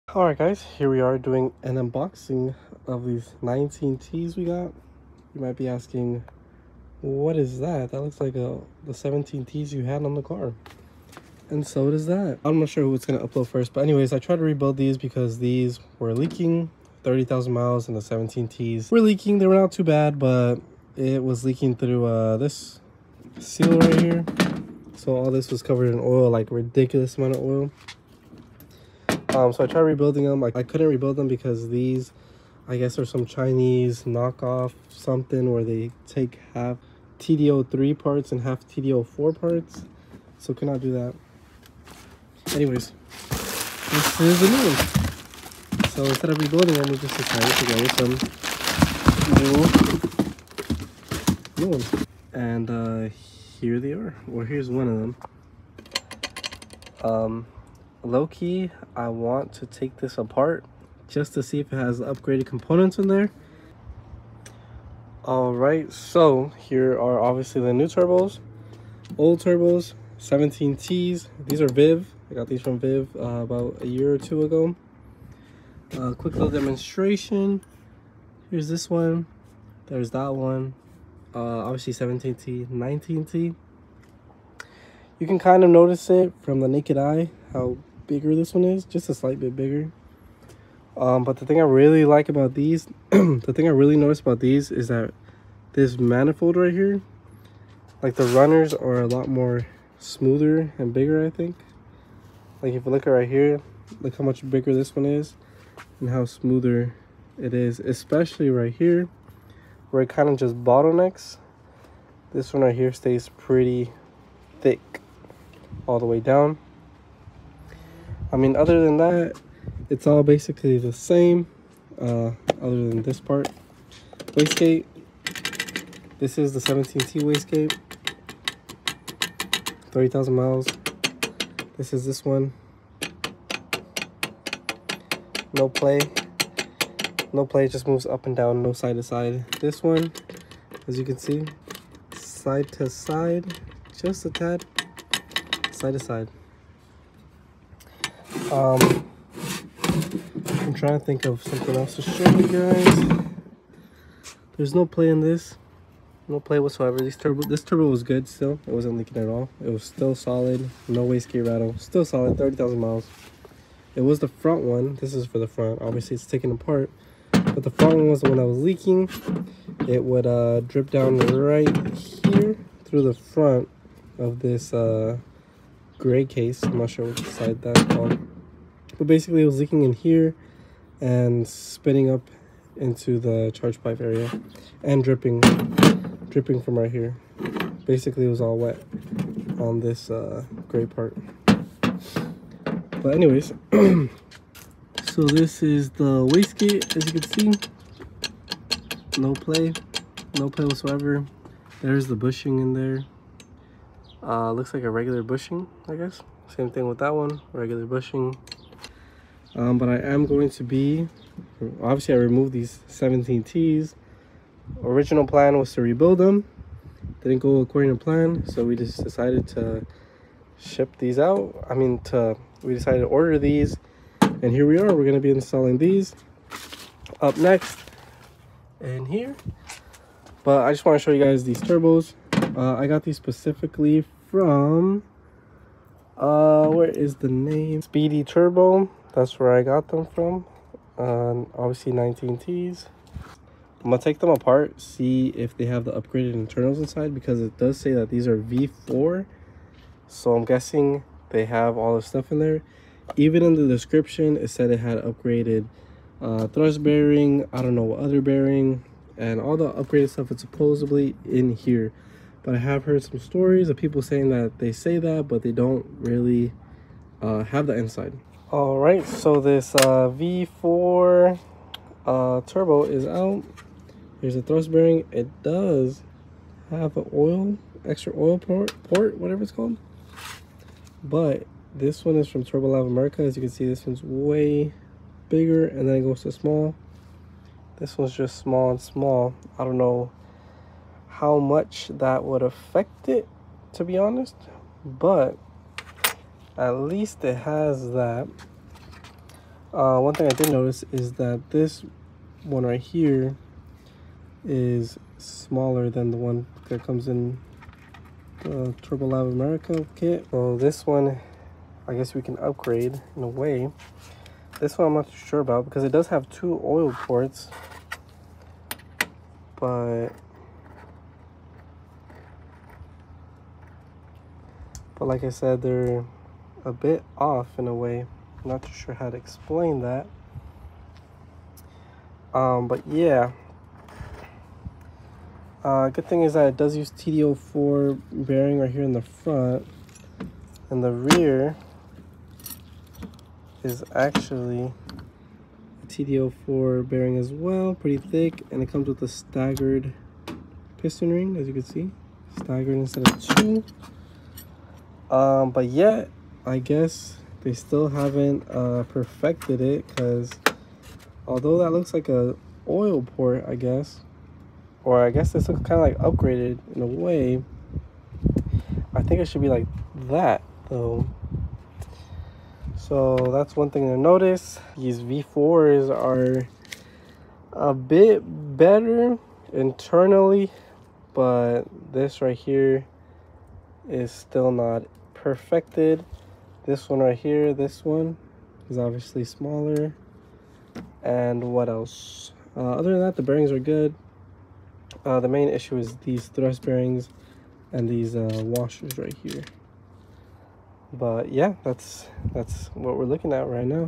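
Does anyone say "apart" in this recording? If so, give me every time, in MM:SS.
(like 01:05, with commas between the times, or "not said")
01:00, 02:46, 04:04.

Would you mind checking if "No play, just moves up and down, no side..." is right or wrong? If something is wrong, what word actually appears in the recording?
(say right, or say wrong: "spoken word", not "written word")
right.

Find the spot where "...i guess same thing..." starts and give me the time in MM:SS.
03:25.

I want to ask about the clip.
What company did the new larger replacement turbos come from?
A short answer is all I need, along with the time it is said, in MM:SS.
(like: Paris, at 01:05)
Speedy Turbo, at 03:57.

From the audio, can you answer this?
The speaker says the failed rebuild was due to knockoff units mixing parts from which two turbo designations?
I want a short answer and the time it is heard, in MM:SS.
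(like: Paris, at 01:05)
TD03 and TD04, at 00:36.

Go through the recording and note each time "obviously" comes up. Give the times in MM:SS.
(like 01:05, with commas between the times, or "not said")
01:07, 01:21, 02:45, 03:31, 04:01, 06:28.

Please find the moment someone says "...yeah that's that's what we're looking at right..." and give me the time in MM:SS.
06:41.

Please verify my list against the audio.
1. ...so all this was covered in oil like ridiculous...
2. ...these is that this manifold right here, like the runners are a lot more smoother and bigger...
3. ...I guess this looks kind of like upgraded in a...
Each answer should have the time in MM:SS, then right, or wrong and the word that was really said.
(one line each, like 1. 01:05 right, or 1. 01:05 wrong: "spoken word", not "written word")
1. 00:24 right
2. 01:34 right
3. 06:05 right.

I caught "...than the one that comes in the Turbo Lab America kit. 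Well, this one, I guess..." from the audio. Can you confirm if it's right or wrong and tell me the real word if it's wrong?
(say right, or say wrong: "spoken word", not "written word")
right.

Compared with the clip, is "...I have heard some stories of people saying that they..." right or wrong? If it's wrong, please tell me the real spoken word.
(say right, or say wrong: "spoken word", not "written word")
right.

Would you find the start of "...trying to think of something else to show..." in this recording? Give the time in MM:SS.
02:30.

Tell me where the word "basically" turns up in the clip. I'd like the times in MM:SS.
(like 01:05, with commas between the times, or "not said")
02:00, 02:59, 03:07.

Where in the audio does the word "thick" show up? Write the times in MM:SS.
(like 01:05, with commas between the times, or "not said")
01:54, 05:47.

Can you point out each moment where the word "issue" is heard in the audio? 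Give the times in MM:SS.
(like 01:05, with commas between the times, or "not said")
06:35.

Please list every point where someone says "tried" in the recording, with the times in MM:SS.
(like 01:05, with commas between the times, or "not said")
00:14, 00:29.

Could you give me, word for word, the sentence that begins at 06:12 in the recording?
So that's one thing to notice.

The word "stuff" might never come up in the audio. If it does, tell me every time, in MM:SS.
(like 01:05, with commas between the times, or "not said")
04:12, 04:20.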